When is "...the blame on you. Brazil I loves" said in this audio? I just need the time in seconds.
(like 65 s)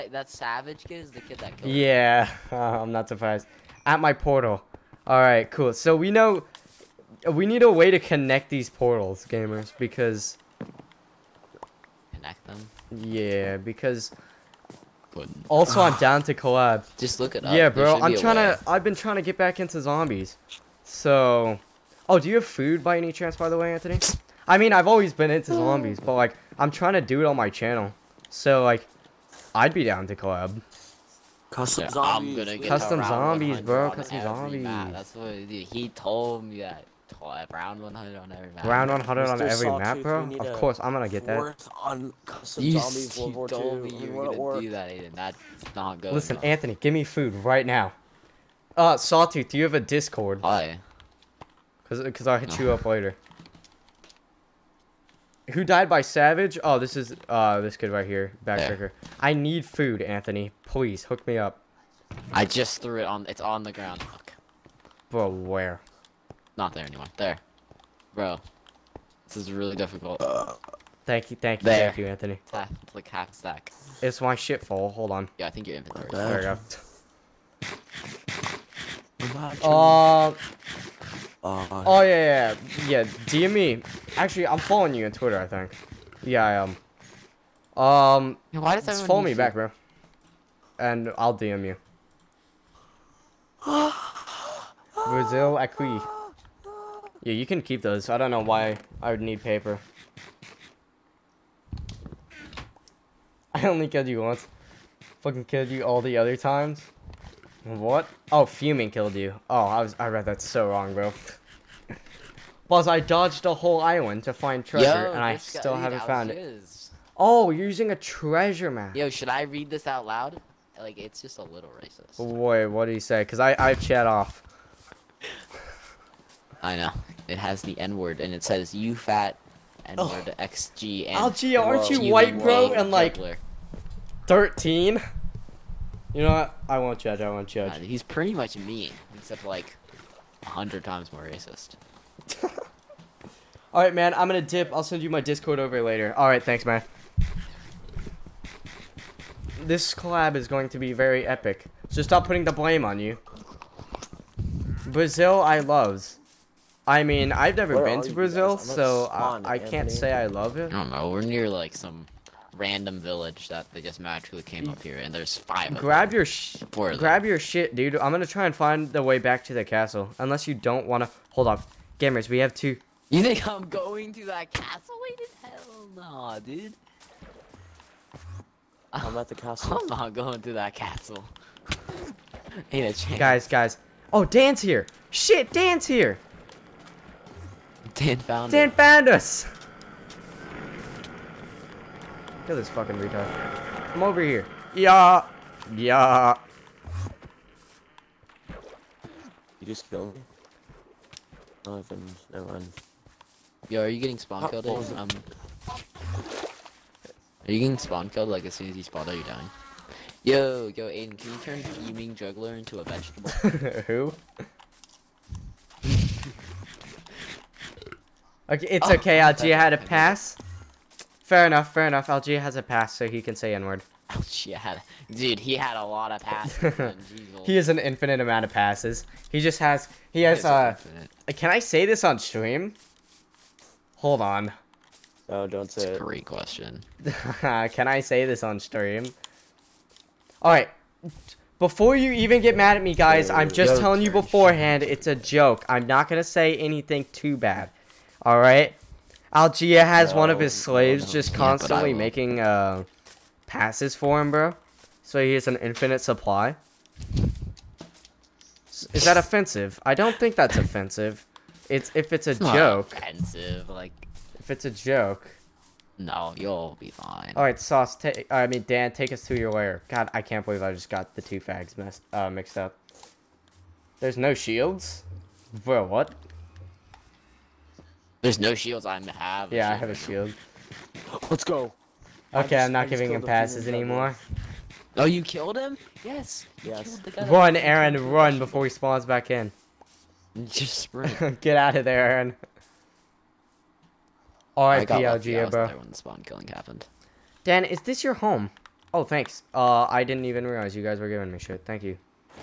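152 s.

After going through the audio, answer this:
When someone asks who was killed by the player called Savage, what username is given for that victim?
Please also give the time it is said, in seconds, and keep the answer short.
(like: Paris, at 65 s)
Backtracker, at 58 s.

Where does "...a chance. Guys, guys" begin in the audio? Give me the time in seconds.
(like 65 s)
182 s.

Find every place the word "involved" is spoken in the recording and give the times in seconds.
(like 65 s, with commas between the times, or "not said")
not said.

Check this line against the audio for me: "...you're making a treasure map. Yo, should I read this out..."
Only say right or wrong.
wrong.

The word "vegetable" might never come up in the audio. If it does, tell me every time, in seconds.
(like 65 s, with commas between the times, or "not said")
212 s.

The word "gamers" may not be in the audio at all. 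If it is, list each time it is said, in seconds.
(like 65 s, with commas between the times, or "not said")
9 s, 171 s.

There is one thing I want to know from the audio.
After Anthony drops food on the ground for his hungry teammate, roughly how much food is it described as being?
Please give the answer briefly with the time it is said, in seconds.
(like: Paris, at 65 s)
Half stack, at 73 s.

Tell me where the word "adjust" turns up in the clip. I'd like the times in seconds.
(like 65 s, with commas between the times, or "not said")
not said.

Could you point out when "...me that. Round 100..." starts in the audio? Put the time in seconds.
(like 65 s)
36 s.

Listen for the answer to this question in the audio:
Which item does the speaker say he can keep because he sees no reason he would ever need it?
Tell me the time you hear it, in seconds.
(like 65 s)
99 s.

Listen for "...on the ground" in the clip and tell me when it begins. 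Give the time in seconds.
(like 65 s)
63 s.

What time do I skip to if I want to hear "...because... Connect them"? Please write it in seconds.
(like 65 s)
9 s.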